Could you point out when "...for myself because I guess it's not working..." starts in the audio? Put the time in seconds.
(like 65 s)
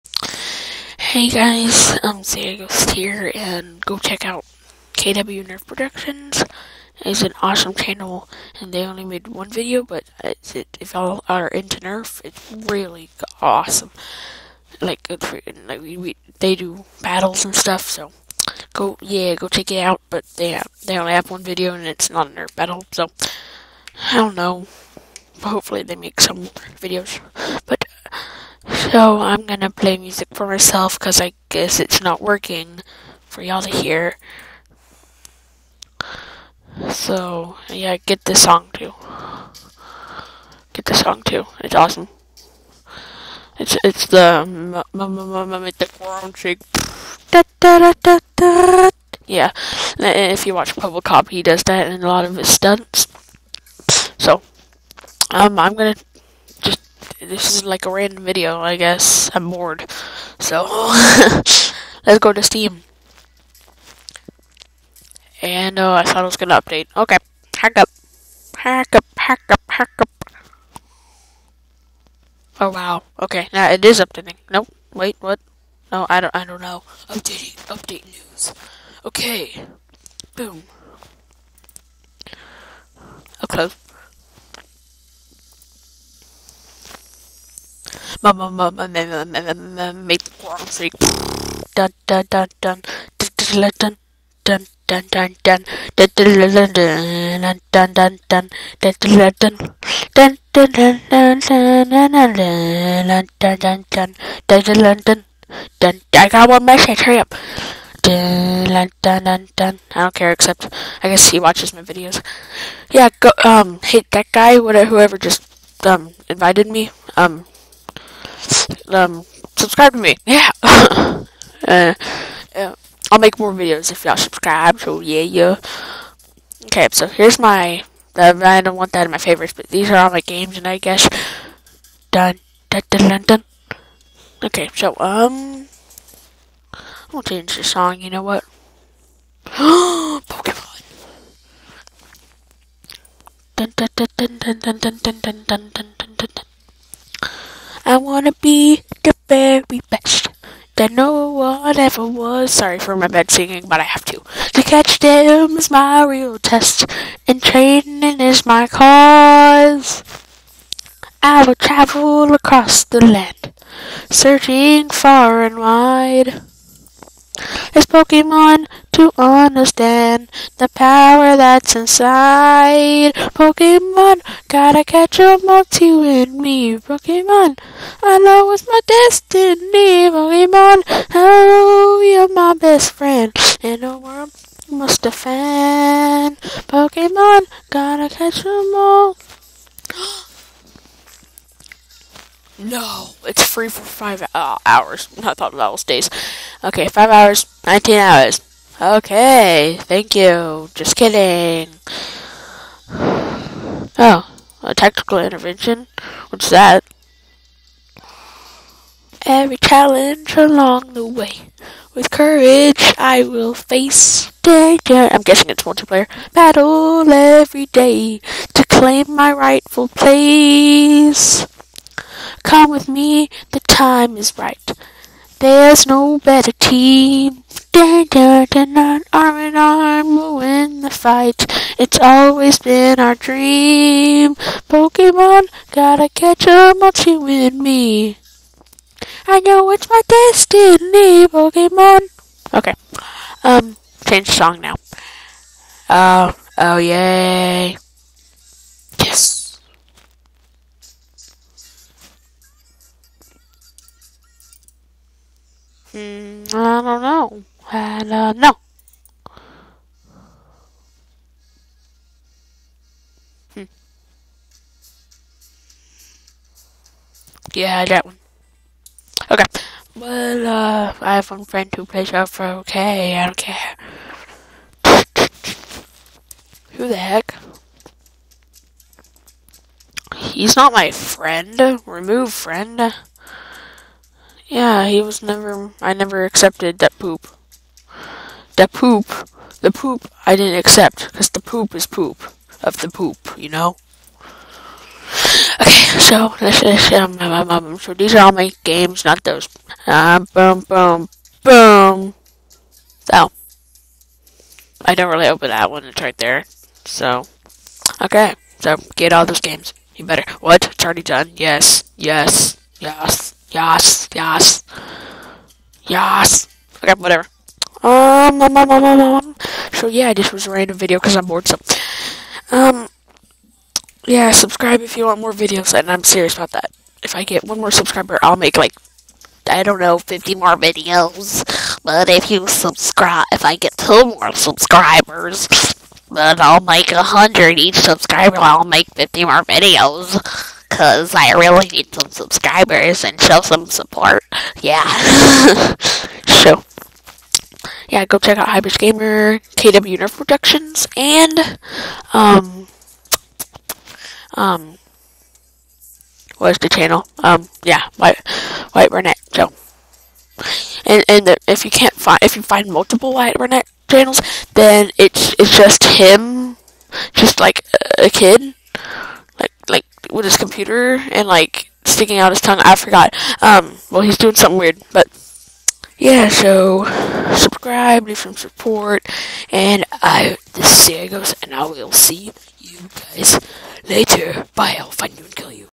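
30 s.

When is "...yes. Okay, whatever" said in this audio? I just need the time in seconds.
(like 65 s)
315 s.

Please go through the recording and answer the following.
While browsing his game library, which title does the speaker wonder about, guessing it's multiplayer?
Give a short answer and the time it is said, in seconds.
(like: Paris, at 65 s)
Tactical Intervention, at 204 s.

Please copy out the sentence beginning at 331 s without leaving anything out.
But if you subscribe, if I get two more subscribers, then I'll make a hundred each subscriber.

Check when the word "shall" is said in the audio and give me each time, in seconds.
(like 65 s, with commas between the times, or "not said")
not said.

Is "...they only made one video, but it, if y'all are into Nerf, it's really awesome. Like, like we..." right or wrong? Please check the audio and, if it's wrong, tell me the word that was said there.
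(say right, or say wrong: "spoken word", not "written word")
right.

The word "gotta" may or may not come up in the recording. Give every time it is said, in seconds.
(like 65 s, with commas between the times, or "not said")
174 s, 187 s, 235 s.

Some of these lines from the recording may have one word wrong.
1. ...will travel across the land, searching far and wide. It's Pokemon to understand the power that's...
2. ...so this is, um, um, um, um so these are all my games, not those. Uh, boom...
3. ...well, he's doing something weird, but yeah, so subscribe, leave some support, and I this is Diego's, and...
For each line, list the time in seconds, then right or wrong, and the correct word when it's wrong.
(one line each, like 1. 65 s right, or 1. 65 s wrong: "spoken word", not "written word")
1. 161 s right
2. 295 s right
3. 373 s right.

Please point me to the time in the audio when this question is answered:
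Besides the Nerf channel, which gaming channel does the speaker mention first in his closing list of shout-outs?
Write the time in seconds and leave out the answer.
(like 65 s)
348 s.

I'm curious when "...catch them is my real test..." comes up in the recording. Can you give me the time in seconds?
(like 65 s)
154 s.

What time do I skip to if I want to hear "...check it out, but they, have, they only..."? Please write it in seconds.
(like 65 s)
19 s.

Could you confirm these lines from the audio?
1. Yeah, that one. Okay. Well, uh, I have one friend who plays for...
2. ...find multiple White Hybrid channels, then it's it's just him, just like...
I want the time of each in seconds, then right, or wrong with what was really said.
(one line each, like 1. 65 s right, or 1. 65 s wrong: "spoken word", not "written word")
1. 267 s right
2. 362 s wrong: "Burnett", not "Hybrid".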